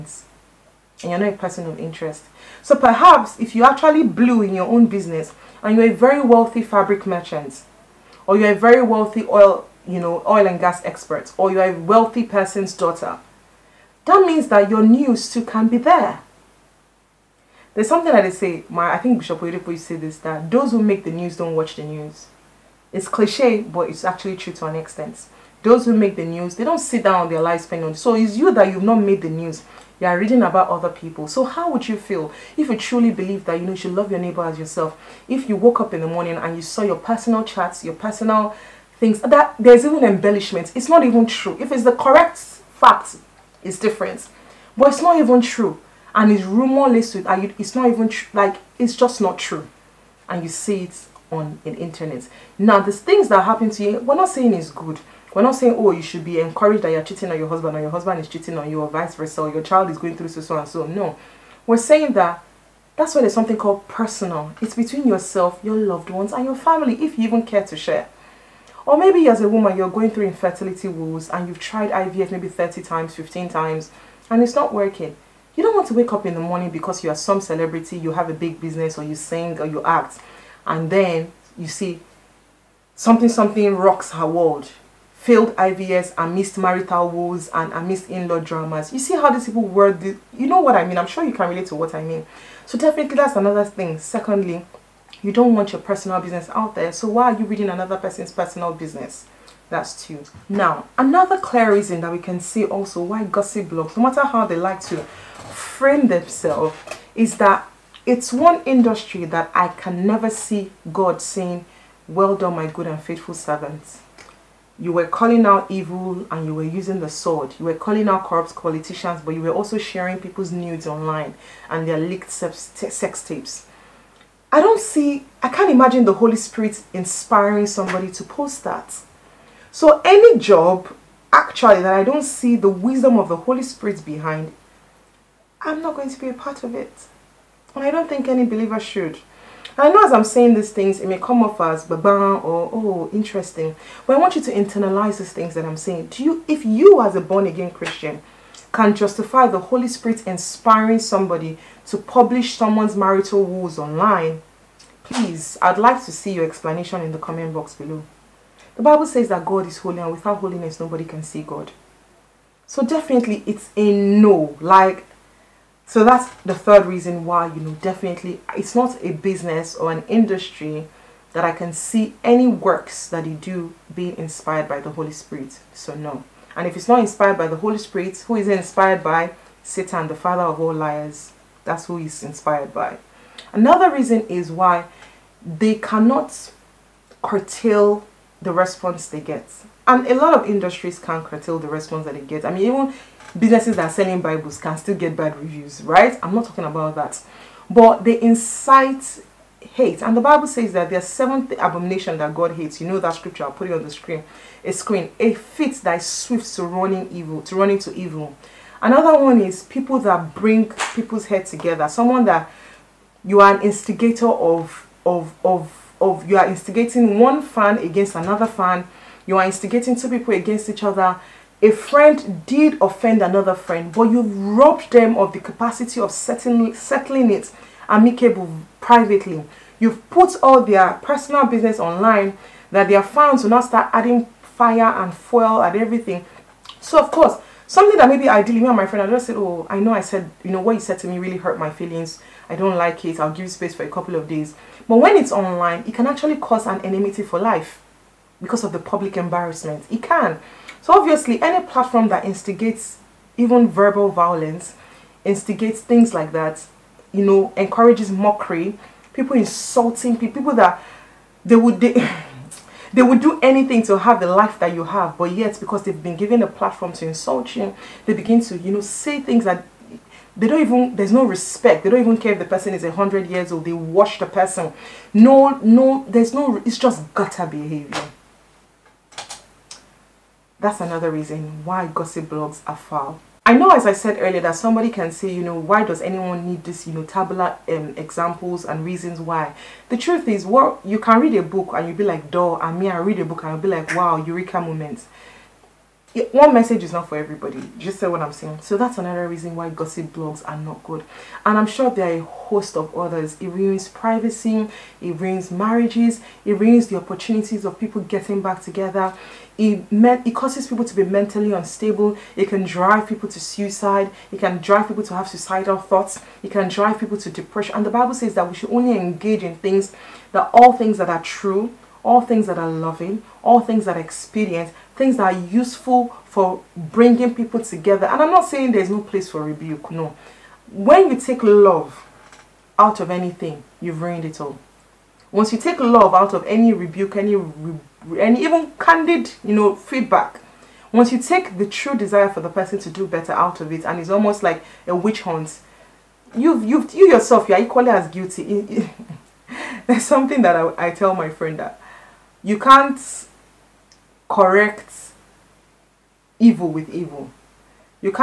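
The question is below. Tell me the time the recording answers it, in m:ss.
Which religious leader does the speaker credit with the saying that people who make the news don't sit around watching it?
0:19.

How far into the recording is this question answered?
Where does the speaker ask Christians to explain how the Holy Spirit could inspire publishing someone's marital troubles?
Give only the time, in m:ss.
2:37.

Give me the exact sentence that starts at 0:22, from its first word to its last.
It's cliche, but it's actually true to an extent.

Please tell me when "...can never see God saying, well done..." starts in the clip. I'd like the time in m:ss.
1:49.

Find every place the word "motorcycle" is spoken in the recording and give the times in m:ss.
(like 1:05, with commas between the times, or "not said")
not said.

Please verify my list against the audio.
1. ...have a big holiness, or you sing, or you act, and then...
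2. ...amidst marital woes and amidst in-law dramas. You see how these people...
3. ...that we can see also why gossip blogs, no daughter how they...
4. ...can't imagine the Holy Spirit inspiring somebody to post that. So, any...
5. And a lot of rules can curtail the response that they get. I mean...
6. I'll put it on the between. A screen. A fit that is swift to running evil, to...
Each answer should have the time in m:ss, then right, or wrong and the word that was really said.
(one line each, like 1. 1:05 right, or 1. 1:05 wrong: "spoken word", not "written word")
1. 1:18 wrong: "business", not "holiness"
2. 1:26 right
3. 1:42 wrong: "matter", not "daughter"
4. 2:05 right
5. 3:09 wrong: "industries", not "rules"
6. 3:23 wrong: "screen", not "between".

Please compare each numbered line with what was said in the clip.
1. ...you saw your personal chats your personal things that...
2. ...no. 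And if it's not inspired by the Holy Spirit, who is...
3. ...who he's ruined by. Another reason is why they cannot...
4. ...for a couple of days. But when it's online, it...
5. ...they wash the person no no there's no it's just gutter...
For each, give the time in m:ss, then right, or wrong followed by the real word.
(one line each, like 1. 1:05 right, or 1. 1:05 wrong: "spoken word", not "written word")
1. 0:36 right
2. 2:55 right
3. 3:01 wrong: "inspired", not "ruined"
4. 4:03 right
5. 4:33 right.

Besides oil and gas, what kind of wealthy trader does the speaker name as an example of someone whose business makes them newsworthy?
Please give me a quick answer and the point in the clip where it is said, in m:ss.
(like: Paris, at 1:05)
Fabric merchant, at 0:06.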